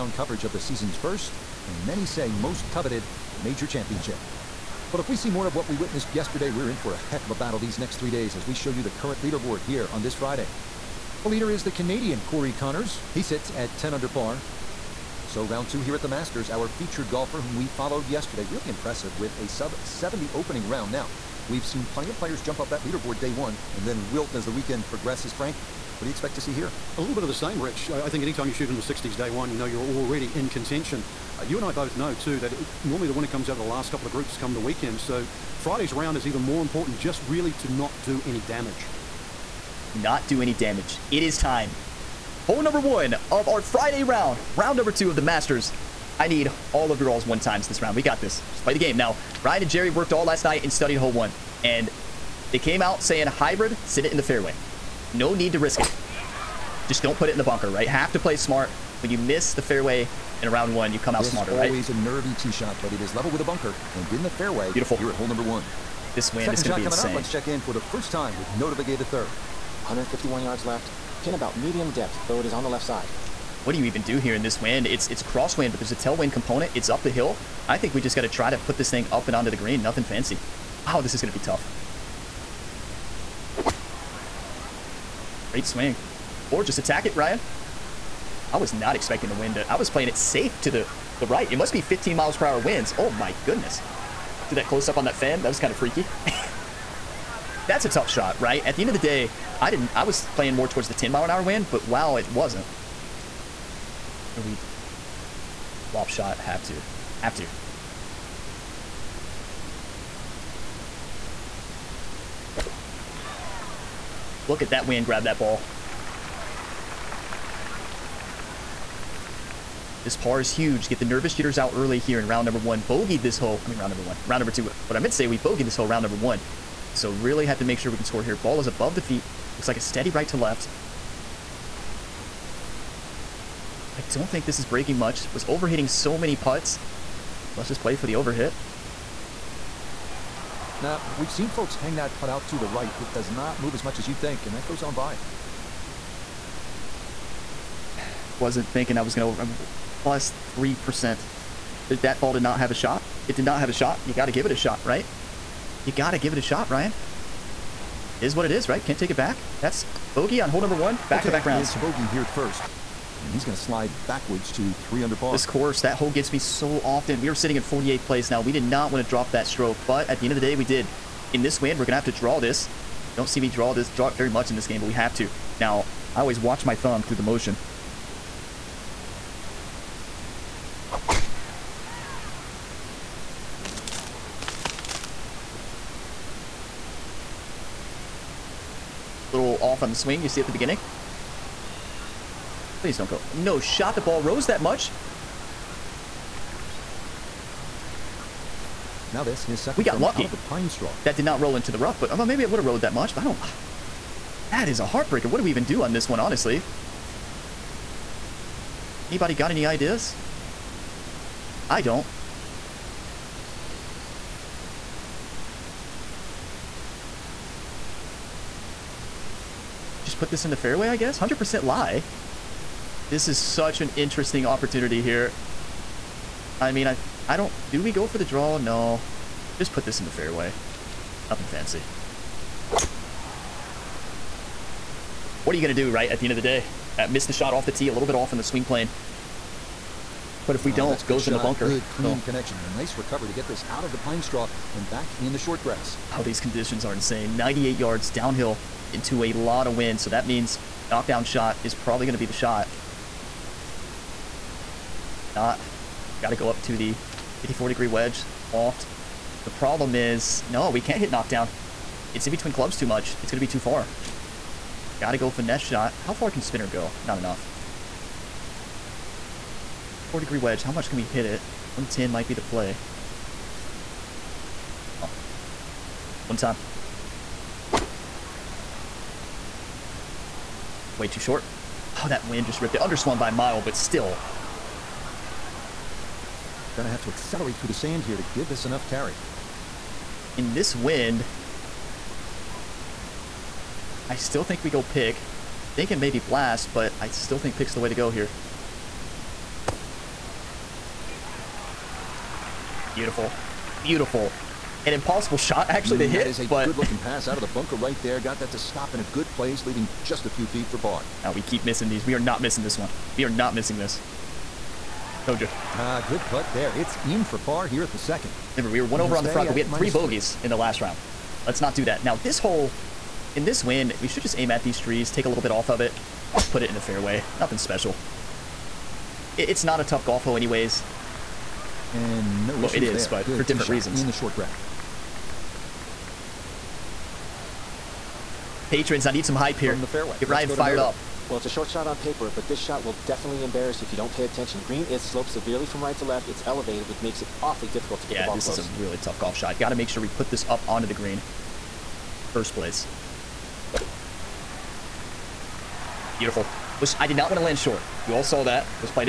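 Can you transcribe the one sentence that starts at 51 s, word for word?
And they came out saying hybrid, sit it in the fairway.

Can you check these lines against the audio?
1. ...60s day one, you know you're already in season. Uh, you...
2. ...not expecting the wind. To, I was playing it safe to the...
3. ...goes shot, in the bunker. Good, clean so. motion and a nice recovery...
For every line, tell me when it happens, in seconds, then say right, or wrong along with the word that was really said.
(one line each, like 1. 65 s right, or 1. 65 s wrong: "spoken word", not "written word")
1. 28 s wrong: "contention", not "season"
2. 88 s right
3. 241 s wrong: "connection", not "motion".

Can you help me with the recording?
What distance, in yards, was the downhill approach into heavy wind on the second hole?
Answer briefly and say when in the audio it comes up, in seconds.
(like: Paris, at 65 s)
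98, at 247 s.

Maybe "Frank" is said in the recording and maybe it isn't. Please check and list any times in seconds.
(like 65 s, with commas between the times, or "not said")
25 s.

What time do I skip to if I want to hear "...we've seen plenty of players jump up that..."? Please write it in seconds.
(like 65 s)
21 s.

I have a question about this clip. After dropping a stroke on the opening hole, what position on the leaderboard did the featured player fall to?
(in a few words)
48th place.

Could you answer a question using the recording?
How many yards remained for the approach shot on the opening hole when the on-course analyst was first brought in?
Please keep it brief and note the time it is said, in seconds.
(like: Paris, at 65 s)
151, at 69 s.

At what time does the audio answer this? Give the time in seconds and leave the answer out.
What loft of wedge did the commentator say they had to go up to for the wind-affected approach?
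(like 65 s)
257 s.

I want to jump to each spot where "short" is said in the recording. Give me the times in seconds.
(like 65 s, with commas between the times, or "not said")
245 s, 281 s, 334 s, 341 s, 357 s.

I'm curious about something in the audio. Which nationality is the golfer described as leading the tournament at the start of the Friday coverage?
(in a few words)
Canadian.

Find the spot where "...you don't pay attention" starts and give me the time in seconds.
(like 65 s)
343 s.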